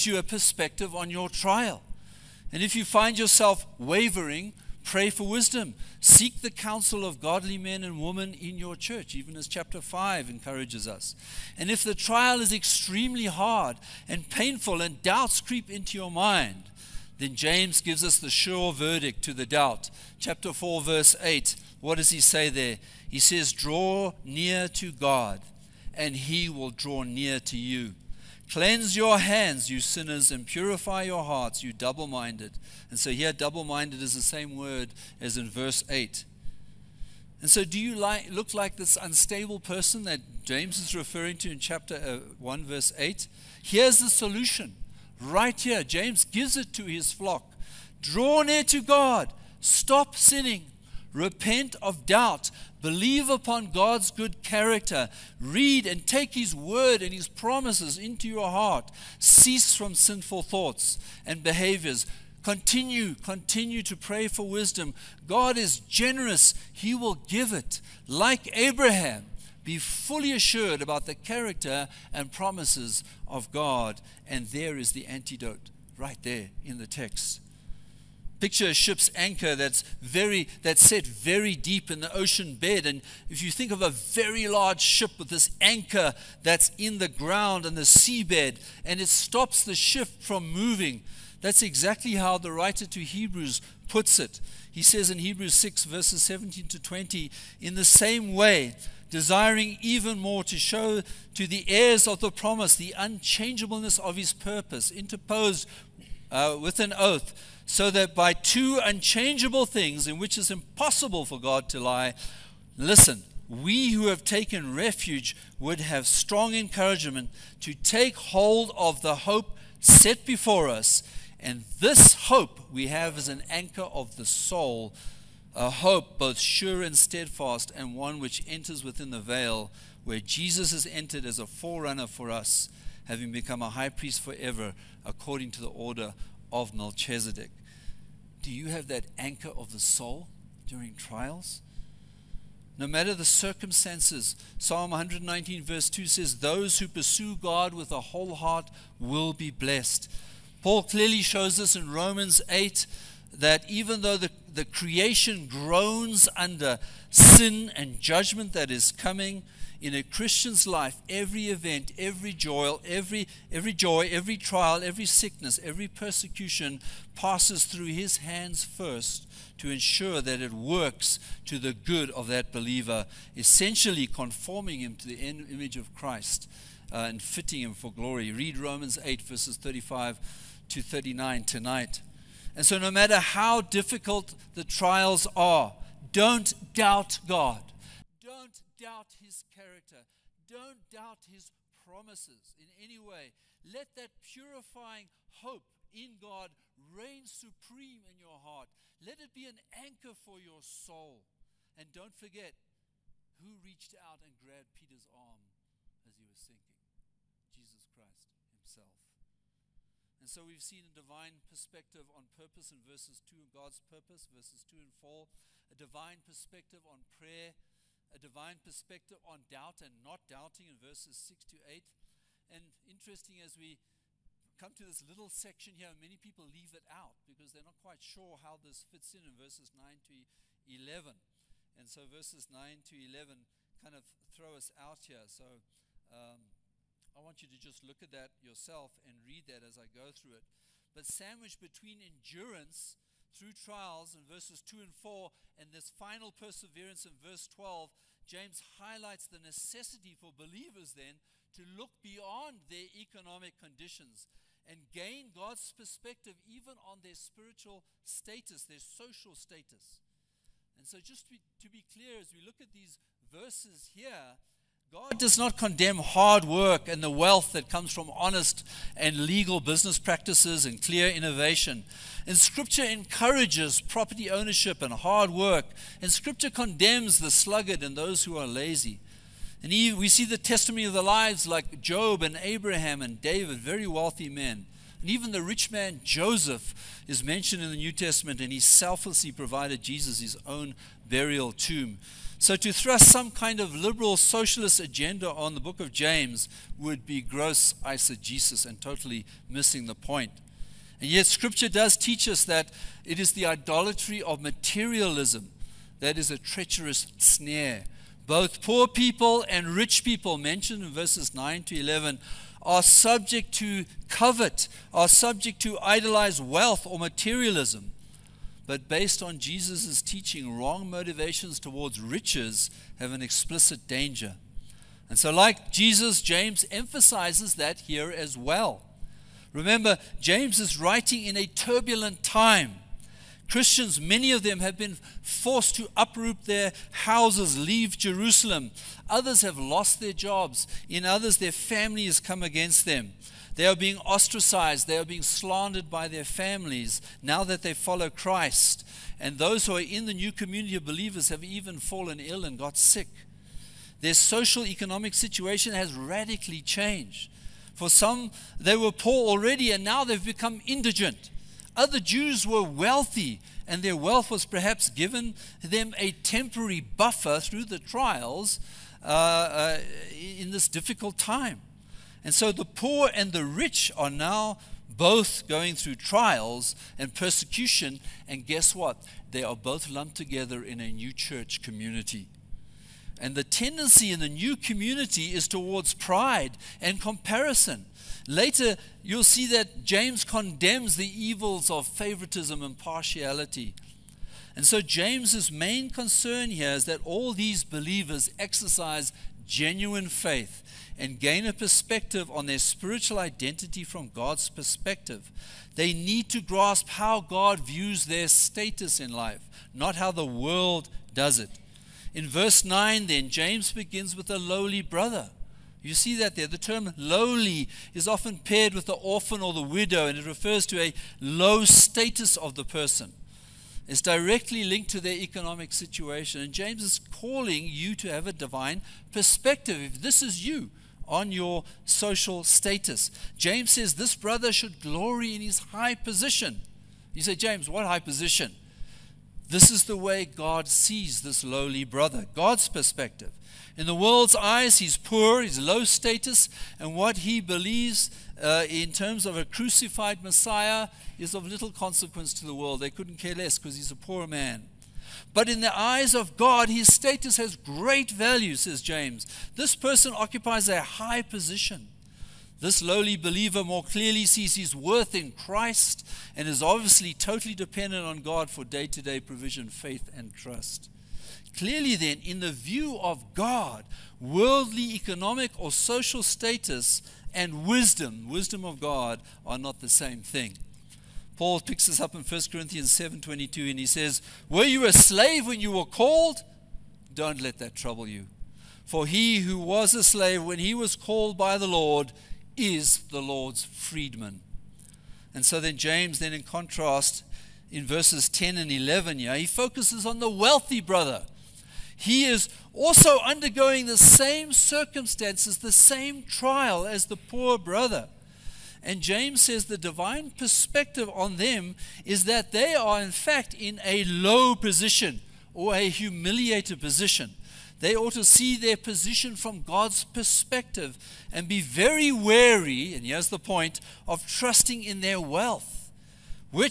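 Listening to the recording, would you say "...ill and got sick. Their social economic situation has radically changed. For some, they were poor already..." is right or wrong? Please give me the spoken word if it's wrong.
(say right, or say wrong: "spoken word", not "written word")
right.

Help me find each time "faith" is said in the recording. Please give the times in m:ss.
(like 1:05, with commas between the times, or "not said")
6:40, 7:49.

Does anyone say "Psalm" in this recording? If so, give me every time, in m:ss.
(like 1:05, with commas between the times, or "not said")
2:24.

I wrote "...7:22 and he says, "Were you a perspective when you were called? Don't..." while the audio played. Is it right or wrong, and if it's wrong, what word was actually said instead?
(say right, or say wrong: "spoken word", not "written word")
wrong: "slave", not "perspective".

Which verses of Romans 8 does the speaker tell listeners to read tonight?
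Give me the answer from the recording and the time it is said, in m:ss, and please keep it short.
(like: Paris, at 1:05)
35 to 39, at 2:59.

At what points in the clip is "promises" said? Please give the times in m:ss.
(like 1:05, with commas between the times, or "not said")
0:57, 1:12, 1:42, 3:11.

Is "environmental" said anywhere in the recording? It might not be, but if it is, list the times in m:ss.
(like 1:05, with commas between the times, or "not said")
not said.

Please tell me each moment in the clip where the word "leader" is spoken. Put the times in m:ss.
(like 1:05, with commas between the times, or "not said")
not said.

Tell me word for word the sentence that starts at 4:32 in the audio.
And Scripture encourages property ownership and hard work.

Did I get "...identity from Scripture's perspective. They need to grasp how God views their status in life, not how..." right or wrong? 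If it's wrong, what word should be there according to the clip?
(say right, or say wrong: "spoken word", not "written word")
wrong: "God", not "Scripture".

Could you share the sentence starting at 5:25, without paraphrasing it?
And so, like Jesus, James emphasizes that here as well.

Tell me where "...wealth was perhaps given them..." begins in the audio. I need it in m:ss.
6:03.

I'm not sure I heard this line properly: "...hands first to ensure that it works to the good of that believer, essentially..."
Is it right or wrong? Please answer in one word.
right.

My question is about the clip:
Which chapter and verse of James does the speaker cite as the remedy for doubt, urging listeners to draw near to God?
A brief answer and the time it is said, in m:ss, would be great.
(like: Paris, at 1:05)
Chapter 4, verse 8, at 0:20.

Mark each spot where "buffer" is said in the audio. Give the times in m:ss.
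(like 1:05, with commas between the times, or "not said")
6:06.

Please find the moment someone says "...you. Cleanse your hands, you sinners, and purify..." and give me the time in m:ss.
0:27.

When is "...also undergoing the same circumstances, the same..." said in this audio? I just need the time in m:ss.
8:22.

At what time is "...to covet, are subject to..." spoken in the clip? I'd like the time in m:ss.
5:13.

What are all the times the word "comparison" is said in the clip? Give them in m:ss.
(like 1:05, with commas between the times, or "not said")
6:26.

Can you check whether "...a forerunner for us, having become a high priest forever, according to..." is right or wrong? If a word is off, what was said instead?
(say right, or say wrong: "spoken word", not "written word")
right.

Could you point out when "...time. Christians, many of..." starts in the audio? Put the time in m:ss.
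5:32.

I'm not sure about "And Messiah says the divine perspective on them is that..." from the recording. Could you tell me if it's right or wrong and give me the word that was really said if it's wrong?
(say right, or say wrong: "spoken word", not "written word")
wrong: "James", not "Messiah".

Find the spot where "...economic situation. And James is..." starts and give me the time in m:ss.
7:05.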